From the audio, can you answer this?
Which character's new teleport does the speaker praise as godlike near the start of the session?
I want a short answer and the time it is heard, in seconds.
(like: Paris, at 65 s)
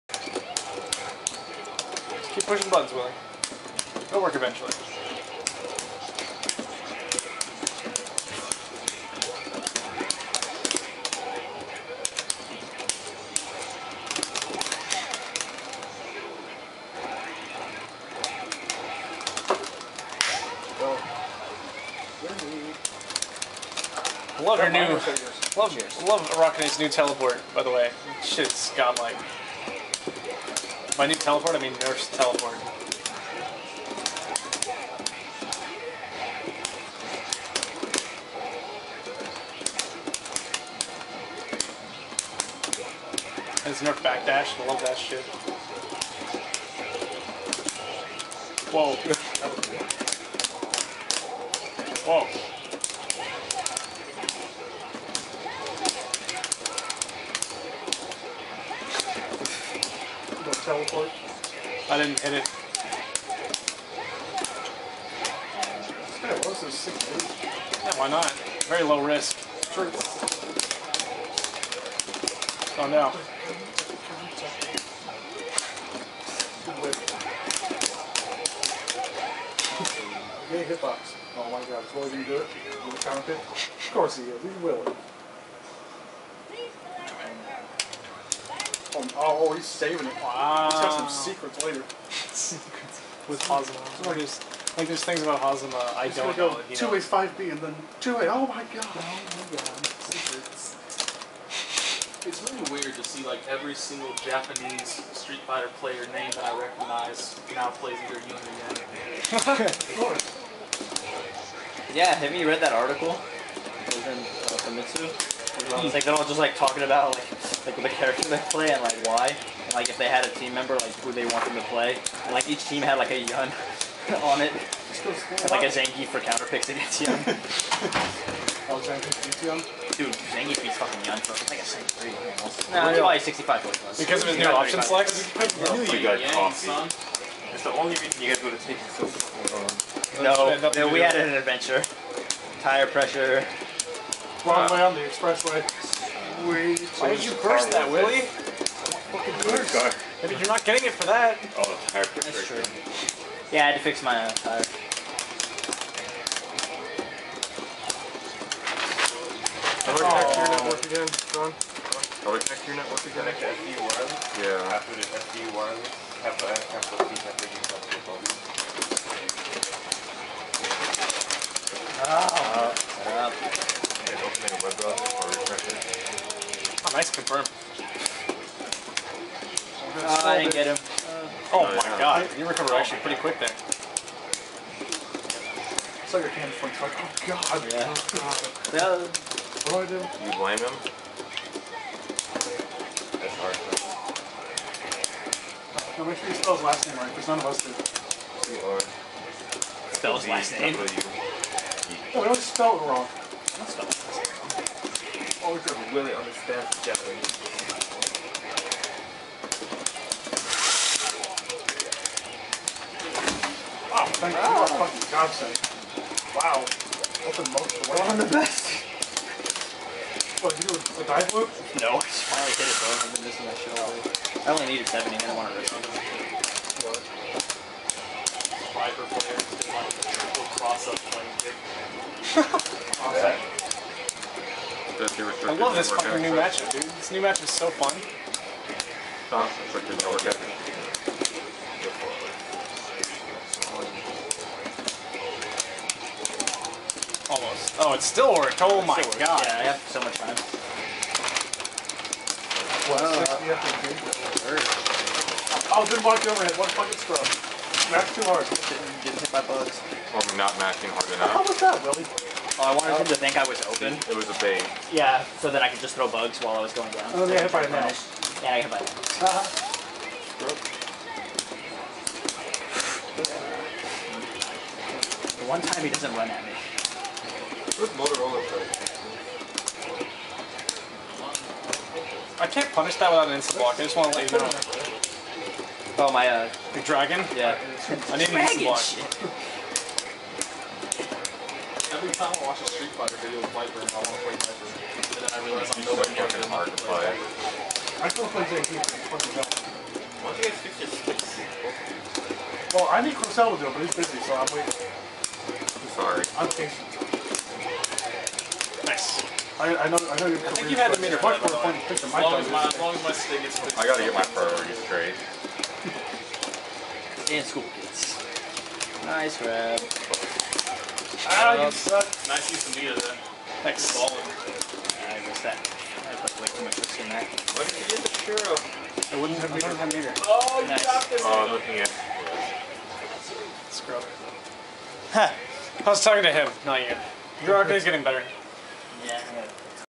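Arakune, at 26 s.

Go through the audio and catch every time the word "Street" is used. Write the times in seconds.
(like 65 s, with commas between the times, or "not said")
105 s, 292 s.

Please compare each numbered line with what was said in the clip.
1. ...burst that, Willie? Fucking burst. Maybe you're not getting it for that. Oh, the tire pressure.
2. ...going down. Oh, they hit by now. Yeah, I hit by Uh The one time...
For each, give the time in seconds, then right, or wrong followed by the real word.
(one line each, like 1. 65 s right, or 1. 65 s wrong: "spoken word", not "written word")
1. 147 s right
2. 266 s right.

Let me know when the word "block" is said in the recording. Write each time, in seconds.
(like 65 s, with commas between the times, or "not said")
283 s, 288 s.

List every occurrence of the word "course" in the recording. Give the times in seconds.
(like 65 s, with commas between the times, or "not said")
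83 s, 109 s.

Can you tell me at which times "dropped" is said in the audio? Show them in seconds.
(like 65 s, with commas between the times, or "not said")
330 s.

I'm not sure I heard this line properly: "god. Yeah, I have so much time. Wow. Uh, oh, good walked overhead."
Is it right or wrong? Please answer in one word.
right.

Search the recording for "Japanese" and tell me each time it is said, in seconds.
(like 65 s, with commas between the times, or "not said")
104 s, 206 s.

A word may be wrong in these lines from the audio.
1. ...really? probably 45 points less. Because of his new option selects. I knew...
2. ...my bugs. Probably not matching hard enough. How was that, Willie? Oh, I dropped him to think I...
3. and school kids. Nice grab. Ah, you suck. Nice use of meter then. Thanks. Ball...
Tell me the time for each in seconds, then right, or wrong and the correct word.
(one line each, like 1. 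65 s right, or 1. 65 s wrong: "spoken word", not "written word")
1. 132 s wrong: "65", not "45"
2. 259 s wrong: "wanted", not "dropped"
3. 317 s right.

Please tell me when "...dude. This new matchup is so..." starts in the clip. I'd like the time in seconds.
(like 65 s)
236 s.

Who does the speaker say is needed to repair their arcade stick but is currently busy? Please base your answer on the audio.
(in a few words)
Crosell.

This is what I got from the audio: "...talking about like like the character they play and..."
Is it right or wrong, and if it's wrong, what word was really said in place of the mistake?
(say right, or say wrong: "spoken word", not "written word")
right.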